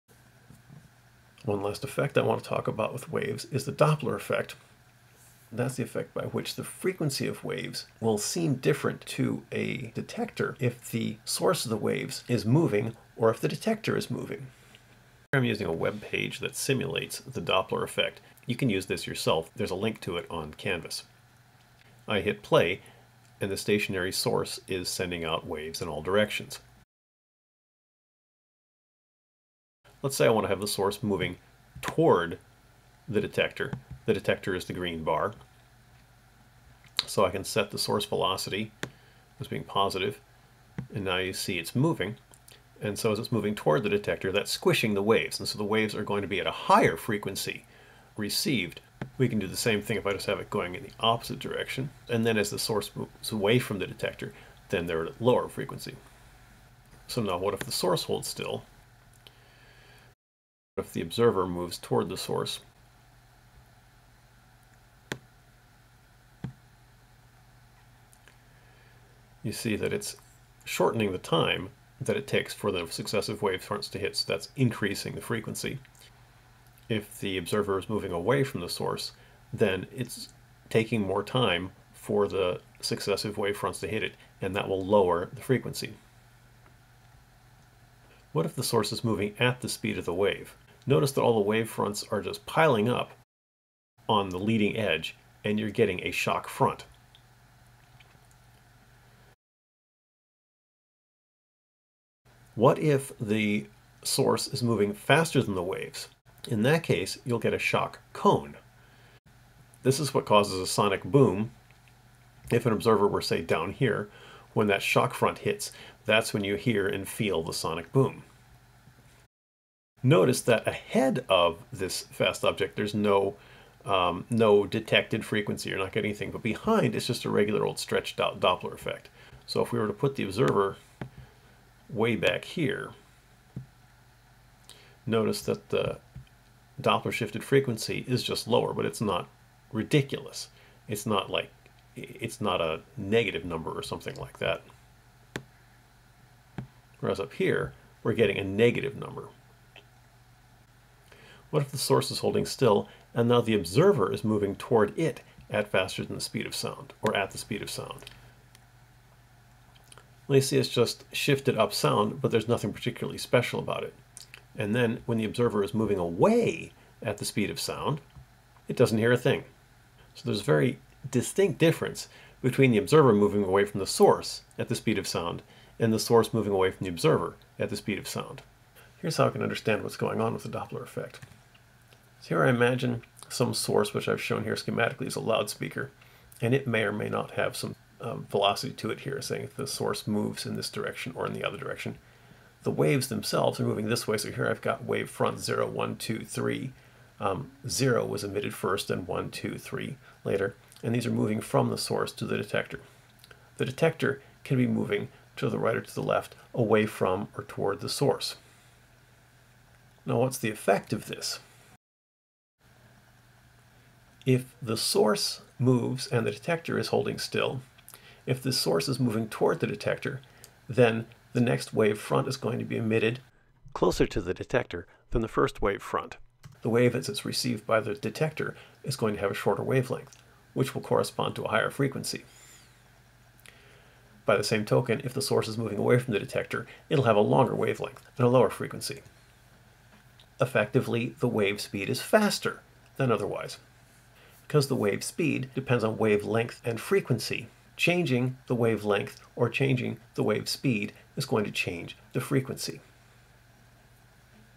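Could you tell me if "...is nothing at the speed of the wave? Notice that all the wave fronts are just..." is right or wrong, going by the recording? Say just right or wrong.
wrong.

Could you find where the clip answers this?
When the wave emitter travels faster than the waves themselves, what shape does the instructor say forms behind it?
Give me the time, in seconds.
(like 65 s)
107 s.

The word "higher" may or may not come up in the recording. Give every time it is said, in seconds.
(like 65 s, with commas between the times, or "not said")
46 s, 231 s.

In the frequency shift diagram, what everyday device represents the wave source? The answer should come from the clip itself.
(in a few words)
Loudspeaker.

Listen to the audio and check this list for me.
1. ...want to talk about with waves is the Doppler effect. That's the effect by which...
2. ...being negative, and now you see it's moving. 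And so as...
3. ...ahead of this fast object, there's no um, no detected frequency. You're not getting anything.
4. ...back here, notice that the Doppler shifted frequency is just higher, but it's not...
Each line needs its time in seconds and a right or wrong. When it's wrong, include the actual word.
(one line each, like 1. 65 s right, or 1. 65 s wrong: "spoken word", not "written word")
1. 2 s right
2. 39 s wrong: "positive", not "negative"
3. 120 s right
4. 132 s wrong: "lower", not "higher".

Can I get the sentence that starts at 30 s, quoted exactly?
Let's say I want to have the source moving toward the detector.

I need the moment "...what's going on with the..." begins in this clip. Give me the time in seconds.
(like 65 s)
179 s.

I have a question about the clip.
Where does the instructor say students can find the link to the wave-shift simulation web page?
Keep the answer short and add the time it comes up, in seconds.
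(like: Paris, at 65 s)
Canvas, at 20 s.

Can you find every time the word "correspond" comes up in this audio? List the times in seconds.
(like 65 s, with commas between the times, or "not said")
230 s.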